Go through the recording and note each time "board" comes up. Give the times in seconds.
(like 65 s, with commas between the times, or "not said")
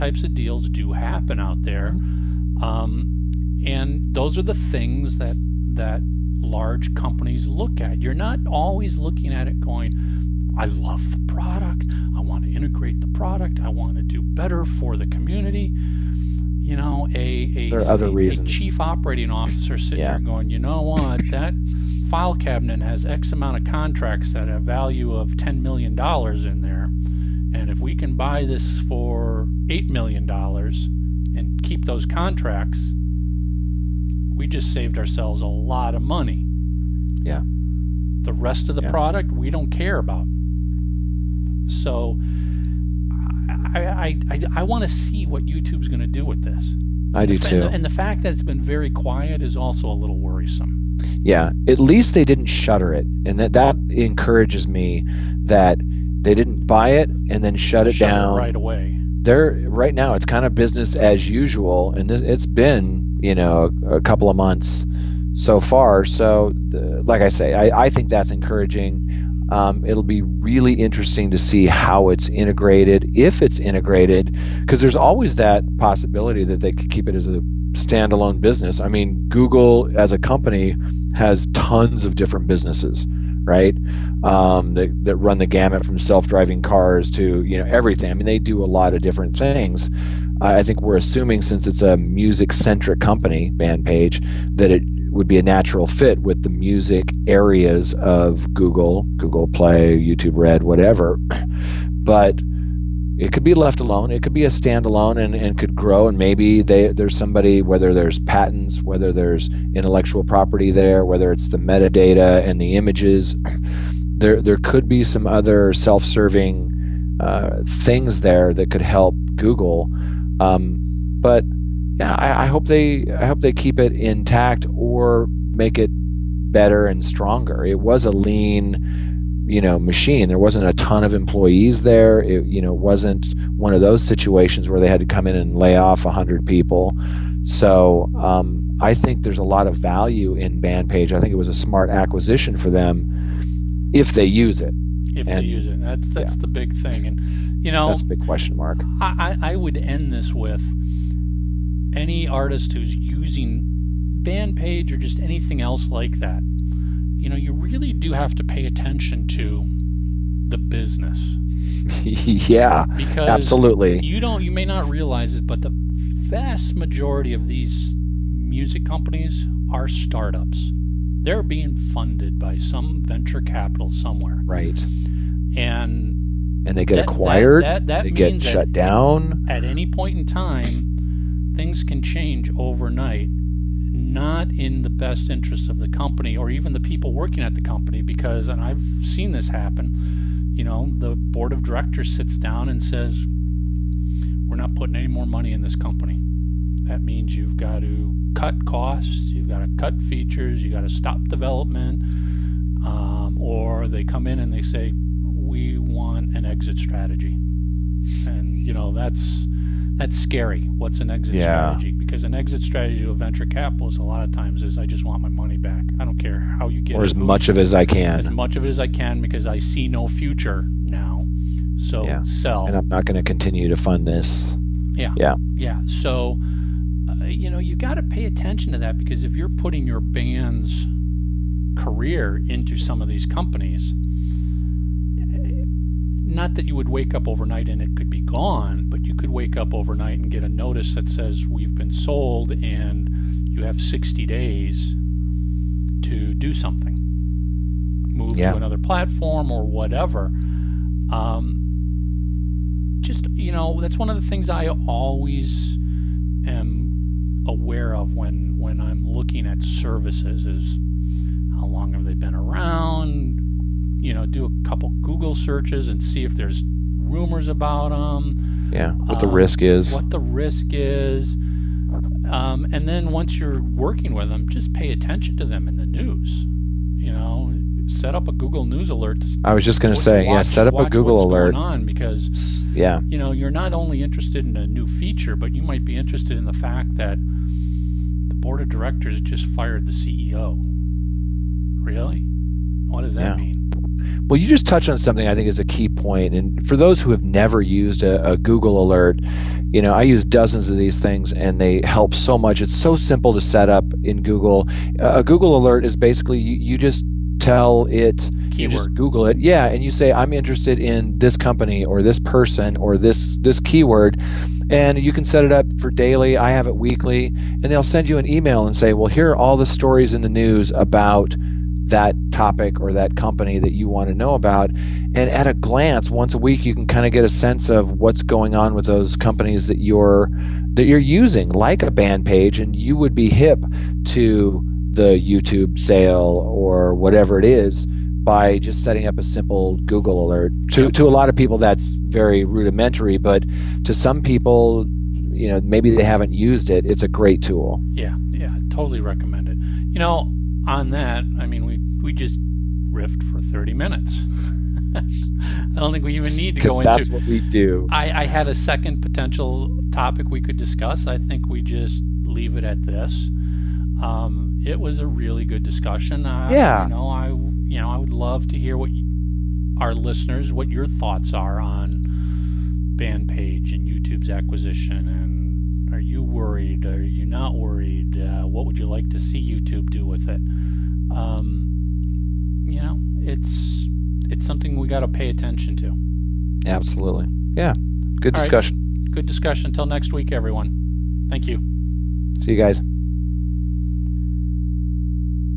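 191 s, 288 s.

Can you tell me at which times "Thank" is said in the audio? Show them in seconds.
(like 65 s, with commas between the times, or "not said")
391 s.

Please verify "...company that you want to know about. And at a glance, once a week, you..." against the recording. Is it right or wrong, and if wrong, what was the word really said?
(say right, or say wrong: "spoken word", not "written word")
right.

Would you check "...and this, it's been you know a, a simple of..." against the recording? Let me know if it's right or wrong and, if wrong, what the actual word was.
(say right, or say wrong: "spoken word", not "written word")
wrong: "couple", not "simple".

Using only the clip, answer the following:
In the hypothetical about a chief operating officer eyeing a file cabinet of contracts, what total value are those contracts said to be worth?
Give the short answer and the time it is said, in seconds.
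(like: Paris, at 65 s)
$10 million, at 25 s.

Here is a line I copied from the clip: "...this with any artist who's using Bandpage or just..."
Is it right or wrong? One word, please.
right.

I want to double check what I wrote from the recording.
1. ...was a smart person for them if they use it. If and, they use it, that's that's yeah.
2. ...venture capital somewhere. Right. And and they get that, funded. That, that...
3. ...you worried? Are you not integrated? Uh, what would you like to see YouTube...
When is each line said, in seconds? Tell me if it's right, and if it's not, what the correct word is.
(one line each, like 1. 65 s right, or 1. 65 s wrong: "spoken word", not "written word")
1. 141 s wrong: "acquisition", not "person"
2. 173 s wrong: "acquired", not "funded"
3. 376 s wrong: "worried", not "integrated".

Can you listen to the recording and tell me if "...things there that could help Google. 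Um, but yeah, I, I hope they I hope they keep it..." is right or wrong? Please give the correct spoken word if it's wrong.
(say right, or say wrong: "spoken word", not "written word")
right.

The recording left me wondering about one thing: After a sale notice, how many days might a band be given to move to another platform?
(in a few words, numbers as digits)
60.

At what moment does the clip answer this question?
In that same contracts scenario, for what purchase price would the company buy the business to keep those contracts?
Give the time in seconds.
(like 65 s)
29 s.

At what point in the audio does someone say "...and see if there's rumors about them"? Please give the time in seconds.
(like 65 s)
265 s.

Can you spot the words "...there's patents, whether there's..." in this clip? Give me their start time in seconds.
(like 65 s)
107 s.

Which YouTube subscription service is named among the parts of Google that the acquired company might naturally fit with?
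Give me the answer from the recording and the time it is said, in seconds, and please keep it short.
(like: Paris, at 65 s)
YouTube Red, at 99 s.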